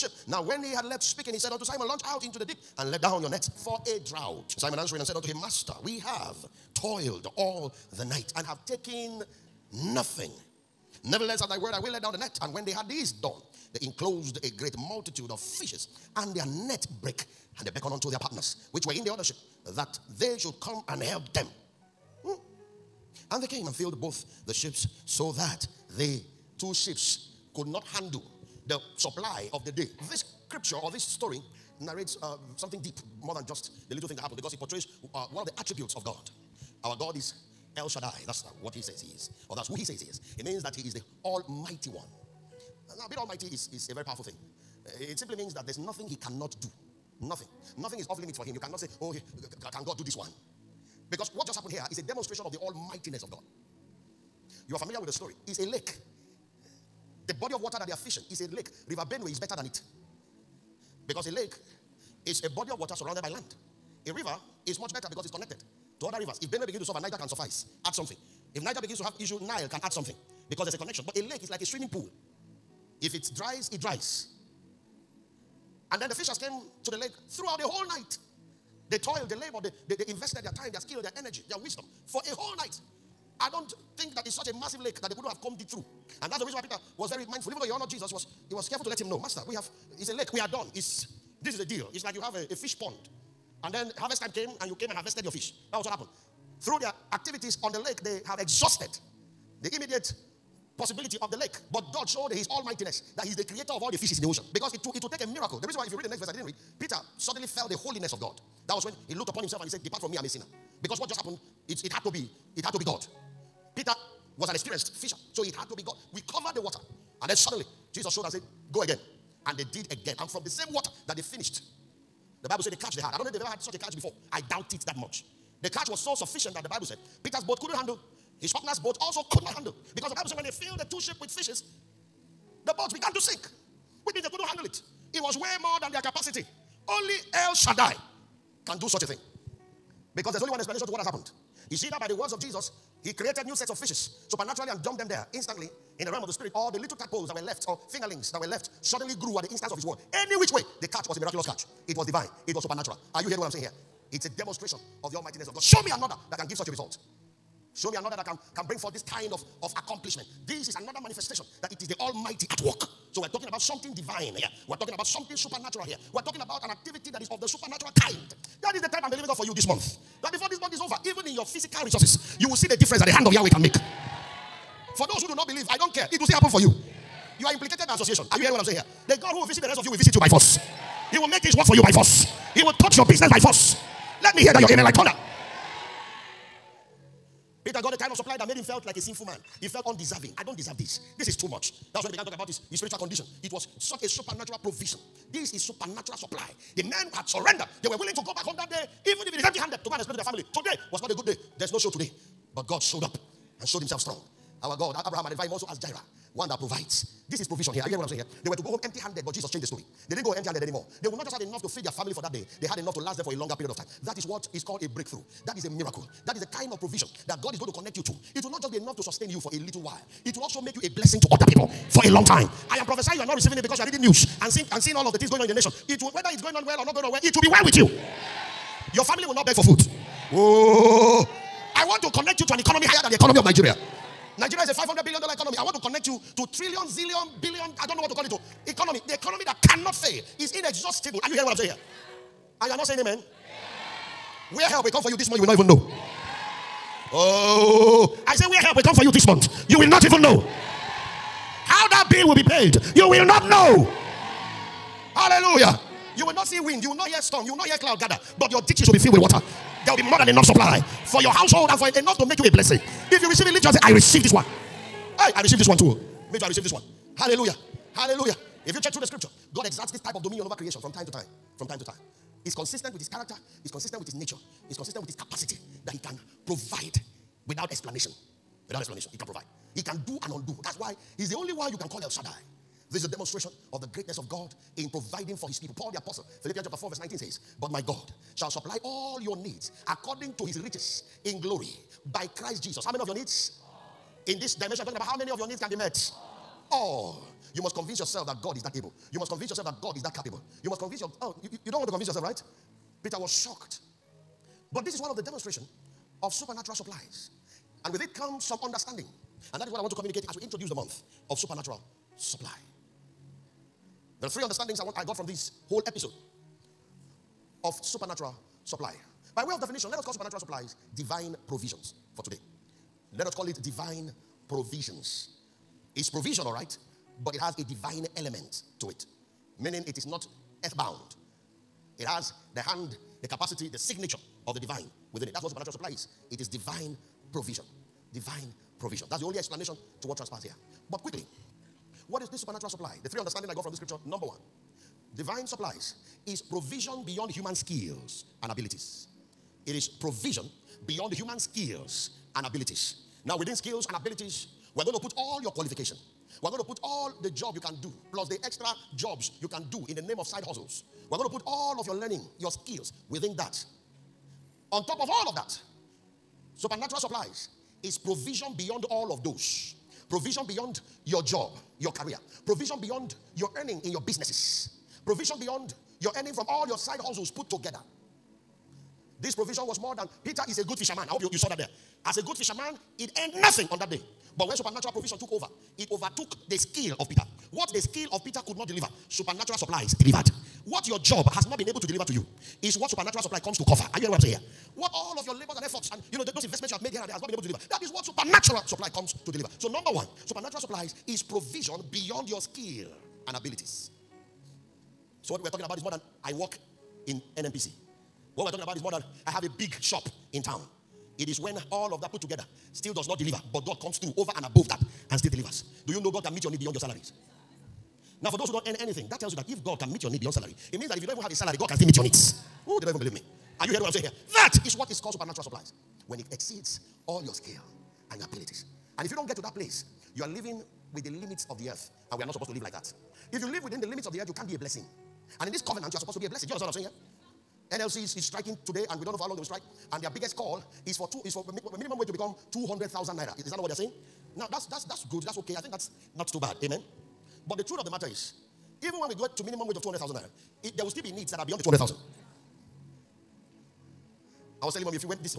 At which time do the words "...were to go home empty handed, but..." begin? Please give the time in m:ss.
3:28.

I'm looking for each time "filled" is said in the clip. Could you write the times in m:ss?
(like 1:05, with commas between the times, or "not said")
0:23, 2:10, 4:18.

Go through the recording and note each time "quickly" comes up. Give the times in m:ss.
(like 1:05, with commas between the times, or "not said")
5:41.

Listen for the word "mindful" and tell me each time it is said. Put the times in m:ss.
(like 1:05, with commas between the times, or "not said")
1:27.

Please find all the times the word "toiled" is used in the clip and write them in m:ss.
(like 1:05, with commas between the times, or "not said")
0:06, 1:18.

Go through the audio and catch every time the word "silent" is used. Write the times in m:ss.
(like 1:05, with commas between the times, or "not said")
not said.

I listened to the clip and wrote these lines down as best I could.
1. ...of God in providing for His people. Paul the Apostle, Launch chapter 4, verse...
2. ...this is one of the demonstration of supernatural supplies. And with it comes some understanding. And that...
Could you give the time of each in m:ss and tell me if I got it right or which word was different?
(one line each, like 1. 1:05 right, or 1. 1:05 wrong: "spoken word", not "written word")
1. 4:44 wrong: "Philippians", not "Launch"
2. 5:04 right.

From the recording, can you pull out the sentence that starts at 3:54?
Nigeria is a $500 billion economy.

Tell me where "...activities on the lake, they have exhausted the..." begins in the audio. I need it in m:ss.
1:37.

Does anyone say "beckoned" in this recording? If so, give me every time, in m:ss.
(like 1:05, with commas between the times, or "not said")
0:17.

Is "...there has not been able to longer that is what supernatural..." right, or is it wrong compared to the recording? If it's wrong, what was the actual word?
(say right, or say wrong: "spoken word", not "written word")
wrong: "deliver", not "longer".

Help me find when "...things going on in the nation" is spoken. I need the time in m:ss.
3:45.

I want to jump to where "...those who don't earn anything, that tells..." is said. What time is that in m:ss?
6:58.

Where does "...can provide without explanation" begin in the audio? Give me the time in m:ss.
4:36.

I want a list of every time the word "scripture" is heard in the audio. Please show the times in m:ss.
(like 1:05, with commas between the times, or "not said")
0:30, 4:29, 5:43.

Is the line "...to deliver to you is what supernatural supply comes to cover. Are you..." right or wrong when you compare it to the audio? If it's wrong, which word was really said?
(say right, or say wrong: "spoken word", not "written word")
right.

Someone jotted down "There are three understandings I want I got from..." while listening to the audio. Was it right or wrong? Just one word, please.
right.